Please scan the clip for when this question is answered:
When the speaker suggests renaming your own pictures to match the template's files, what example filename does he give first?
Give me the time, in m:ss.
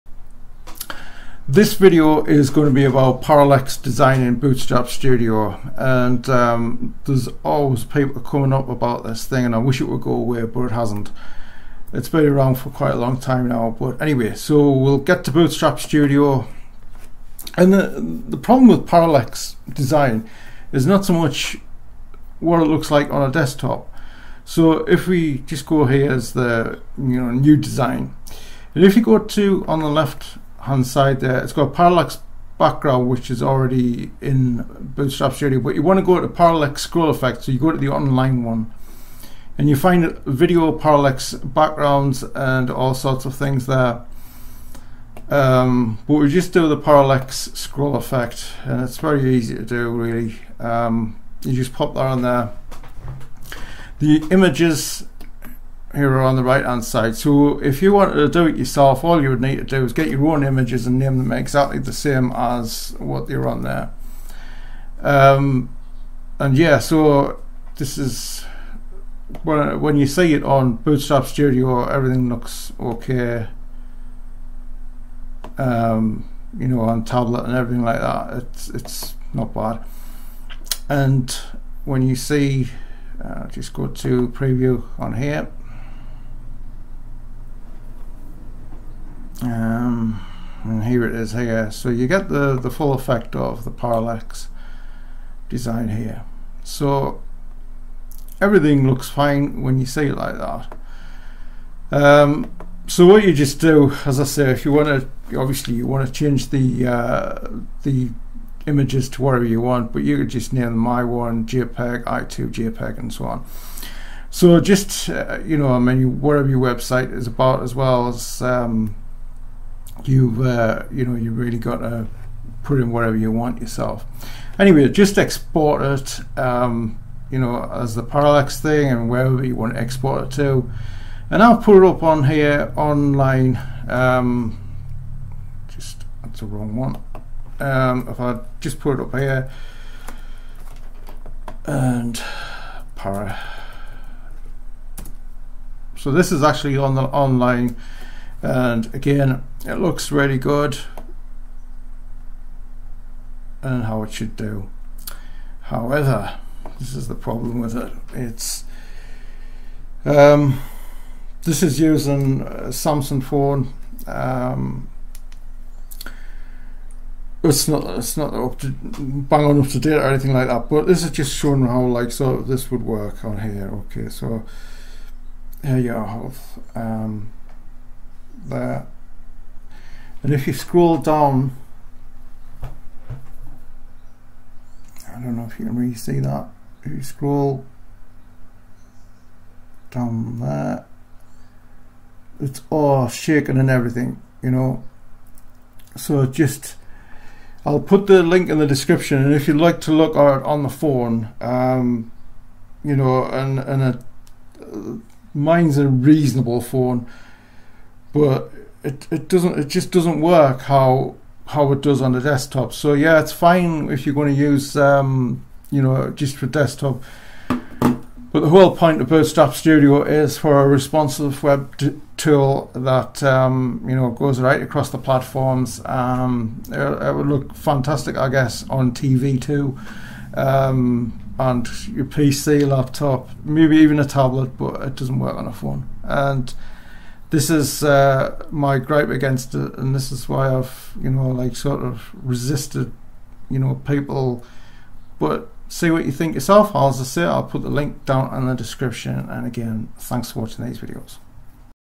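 1:50.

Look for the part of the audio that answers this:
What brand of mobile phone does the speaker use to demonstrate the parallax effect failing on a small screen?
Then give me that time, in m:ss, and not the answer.
2:42.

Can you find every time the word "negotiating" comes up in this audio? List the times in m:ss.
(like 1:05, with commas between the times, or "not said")
not said.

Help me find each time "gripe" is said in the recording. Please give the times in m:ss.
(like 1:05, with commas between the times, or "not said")
3:58.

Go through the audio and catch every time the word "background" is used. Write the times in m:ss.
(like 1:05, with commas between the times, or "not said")
0:32, 0:41.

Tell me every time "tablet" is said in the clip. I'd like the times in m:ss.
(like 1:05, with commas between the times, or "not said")
1:17, 3:54.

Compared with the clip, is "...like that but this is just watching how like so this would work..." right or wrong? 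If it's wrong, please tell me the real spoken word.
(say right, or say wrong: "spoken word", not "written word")
wrong: "showing", not "watching".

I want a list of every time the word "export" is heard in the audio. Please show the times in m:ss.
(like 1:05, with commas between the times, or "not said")
2:05, 2:09.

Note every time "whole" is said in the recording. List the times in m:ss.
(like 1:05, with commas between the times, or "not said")
3:38.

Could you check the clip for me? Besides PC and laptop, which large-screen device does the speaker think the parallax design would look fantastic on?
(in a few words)
TV.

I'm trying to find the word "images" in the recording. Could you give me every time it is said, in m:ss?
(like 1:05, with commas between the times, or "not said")
0:54, 1:00, 1:48.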